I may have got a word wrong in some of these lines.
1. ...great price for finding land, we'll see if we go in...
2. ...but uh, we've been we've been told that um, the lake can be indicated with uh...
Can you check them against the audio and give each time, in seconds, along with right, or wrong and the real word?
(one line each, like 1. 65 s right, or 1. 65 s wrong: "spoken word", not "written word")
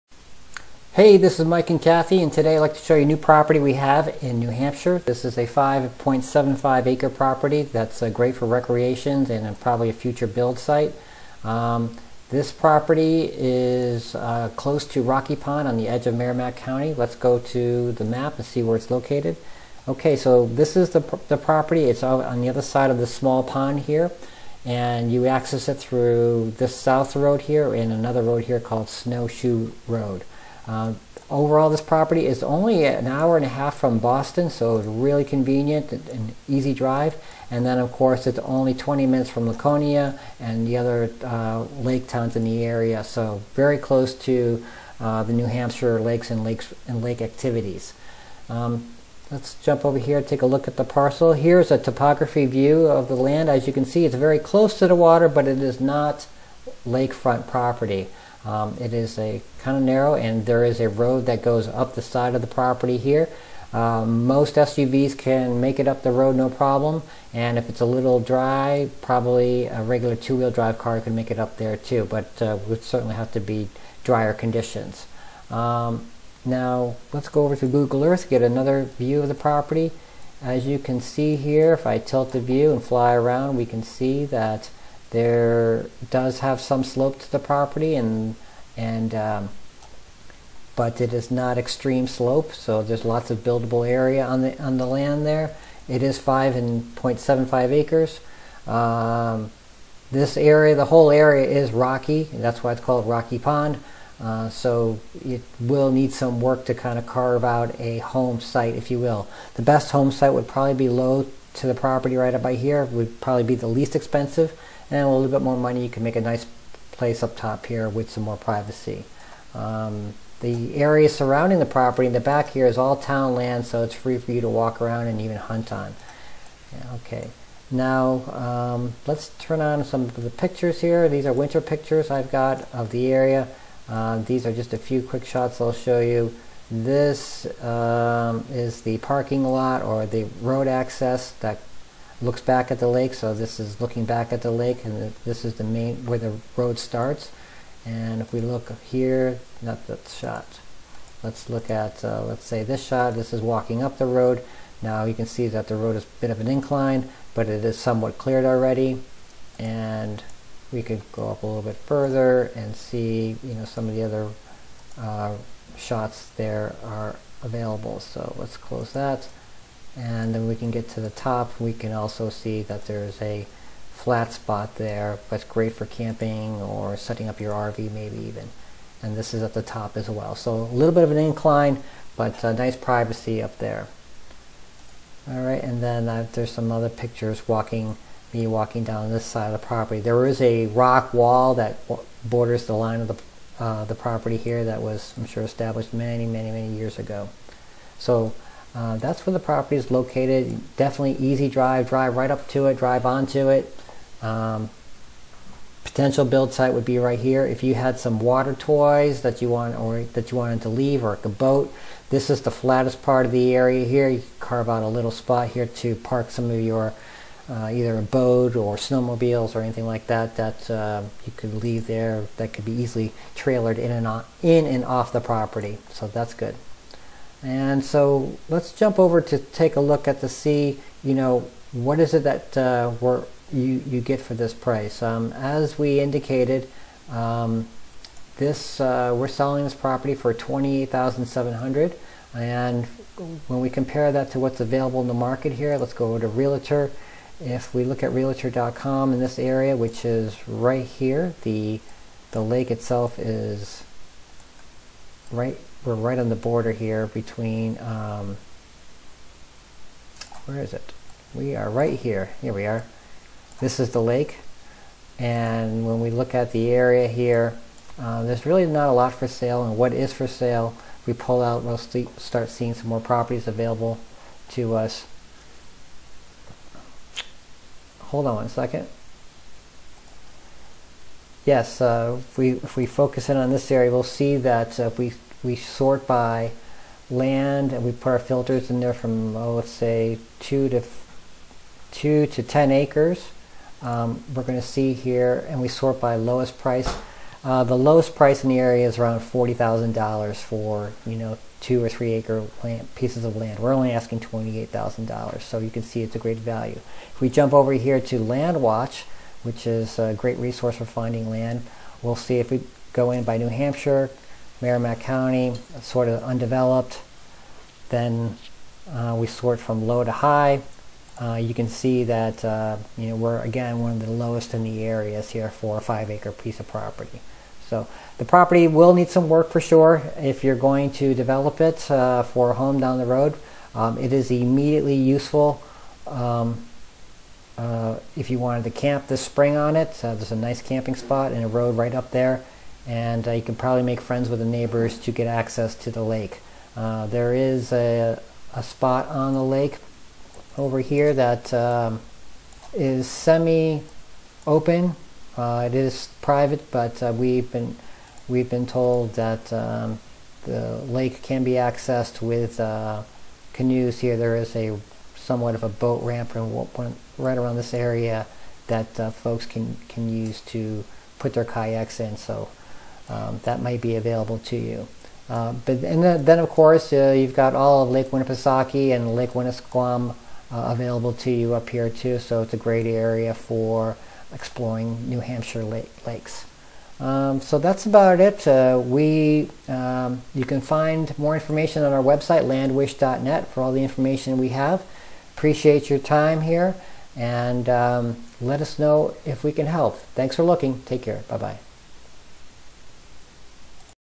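1. 310 s wrong: "resource", not "price"
2. 356 s wrong: "accessed", not "indicated".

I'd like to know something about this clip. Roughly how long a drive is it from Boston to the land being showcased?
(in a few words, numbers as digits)
An hour and a half.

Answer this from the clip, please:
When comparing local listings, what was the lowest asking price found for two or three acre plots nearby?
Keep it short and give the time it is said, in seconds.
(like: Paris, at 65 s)
$40,000, at 299 s.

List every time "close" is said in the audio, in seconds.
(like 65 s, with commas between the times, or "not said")
14 s, 43 s, 54 s, 168 s.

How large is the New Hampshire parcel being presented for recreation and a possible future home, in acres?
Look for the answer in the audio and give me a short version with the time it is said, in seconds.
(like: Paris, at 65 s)
5.75 acres, at 5 s.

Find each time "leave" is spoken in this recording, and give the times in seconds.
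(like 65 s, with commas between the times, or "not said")
210 s, 221 s.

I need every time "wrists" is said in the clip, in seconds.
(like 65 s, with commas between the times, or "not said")
not said.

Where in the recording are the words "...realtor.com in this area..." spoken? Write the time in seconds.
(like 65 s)
248 s.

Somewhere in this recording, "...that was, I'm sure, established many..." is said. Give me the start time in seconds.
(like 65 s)
194 s.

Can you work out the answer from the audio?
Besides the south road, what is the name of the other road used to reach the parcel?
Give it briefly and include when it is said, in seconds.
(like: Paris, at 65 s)
Snowshoe Road, at 28 s.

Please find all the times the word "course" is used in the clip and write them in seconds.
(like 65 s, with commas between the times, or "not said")
37 s, 376 s.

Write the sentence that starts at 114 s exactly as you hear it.
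And a little bit more money, you can make a nice place up top here with some more privacy.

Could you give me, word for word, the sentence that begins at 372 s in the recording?
So um, that might be available to you.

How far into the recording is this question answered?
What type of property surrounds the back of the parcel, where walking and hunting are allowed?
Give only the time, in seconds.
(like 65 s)
122 s.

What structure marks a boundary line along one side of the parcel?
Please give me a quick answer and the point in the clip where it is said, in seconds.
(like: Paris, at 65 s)
A rock wall, at 190 s.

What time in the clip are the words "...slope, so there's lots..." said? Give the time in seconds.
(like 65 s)
92 s.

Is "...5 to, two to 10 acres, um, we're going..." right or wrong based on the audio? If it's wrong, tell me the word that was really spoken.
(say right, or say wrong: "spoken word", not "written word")
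wrong: "2", not "5".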